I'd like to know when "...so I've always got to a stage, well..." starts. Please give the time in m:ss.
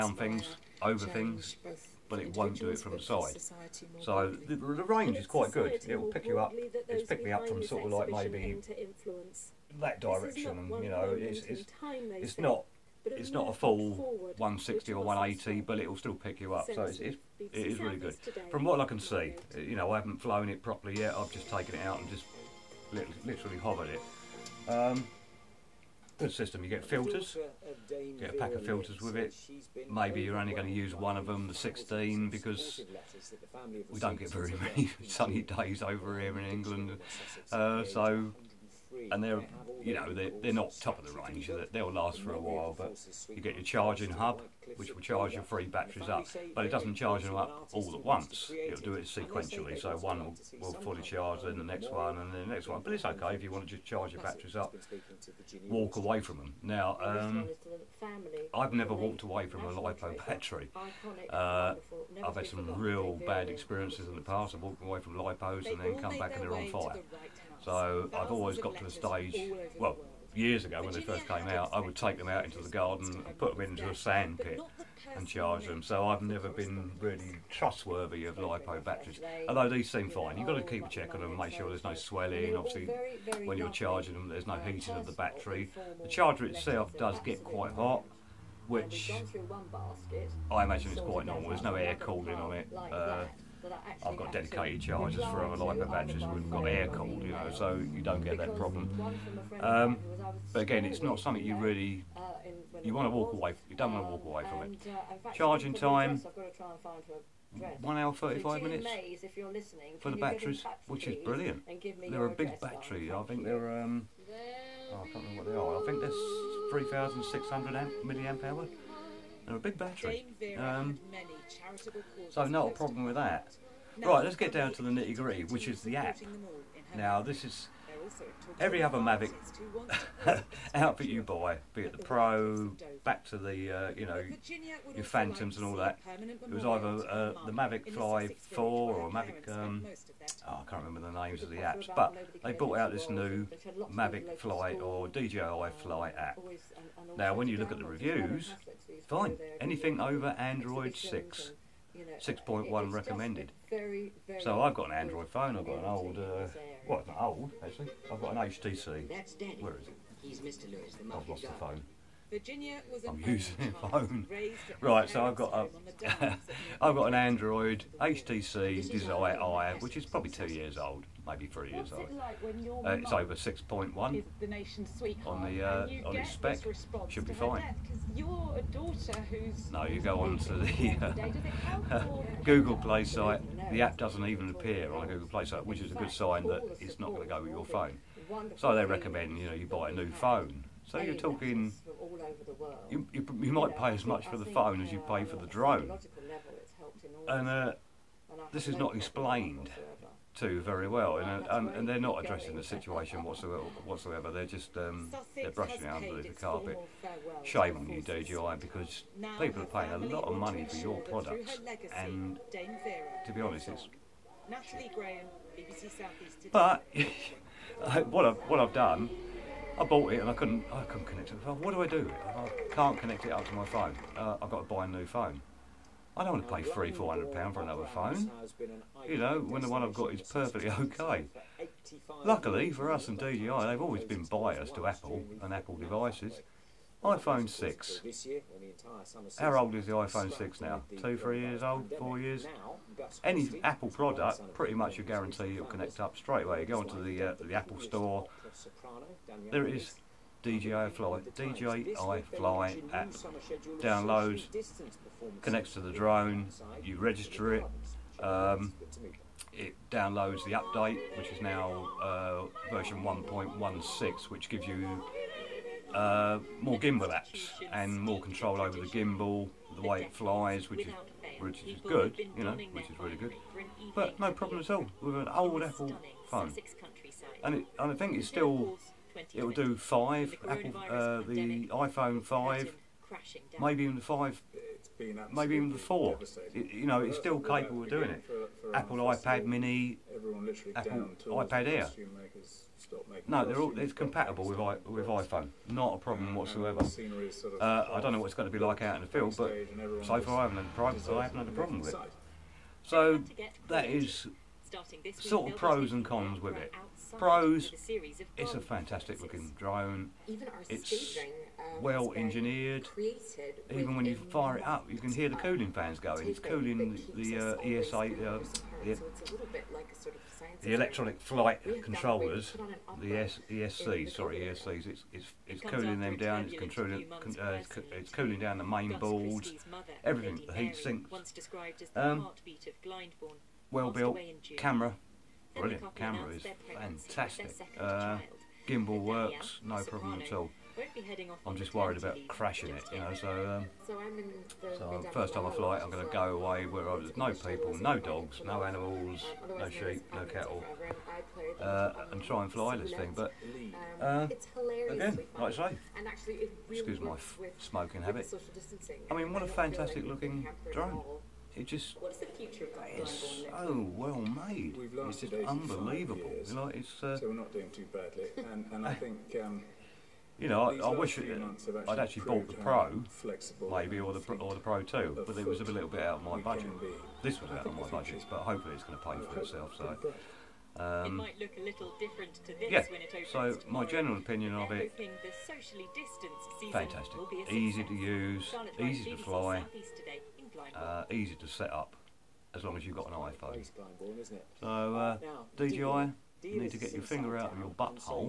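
1:07.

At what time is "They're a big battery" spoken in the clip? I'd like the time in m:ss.
1:52.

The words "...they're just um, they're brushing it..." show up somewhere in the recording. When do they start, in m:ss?
3:24.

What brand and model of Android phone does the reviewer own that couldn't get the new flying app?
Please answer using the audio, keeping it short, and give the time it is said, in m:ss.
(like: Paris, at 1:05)
HTC Desire, at 2:48.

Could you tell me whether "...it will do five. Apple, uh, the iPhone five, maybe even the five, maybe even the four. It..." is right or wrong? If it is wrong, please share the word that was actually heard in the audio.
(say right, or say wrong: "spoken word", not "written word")
right.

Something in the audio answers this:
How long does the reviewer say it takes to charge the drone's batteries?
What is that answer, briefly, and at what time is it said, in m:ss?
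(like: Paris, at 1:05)
1 hour 35 minutes, at 1:47.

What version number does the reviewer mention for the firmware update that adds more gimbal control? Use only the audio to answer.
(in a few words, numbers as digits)
1.16.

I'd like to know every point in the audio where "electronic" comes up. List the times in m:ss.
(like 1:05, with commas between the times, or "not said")
5:20.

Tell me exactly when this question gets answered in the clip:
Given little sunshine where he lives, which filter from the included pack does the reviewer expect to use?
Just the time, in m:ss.
0:31.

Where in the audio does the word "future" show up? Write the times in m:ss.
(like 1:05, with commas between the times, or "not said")
6:02.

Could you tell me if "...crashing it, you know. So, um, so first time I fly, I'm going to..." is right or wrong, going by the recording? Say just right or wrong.
right.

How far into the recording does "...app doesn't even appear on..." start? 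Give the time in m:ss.
3:03.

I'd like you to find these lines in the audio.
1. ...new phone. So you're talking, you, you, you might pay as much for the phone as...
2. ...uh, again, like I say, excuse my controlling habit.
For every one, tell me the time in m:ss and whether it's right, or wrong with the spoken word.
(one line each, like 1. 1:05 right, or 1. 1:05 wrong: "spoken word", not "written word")
1. 3:09 right
2. 5:54 wrong: "smoking", not "controlling".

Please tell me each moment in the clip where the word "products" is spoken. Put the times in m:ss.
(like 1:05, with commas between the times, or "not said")
3:31, 4:03.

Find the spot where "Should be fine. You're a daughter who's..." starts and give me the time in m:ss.
2:57.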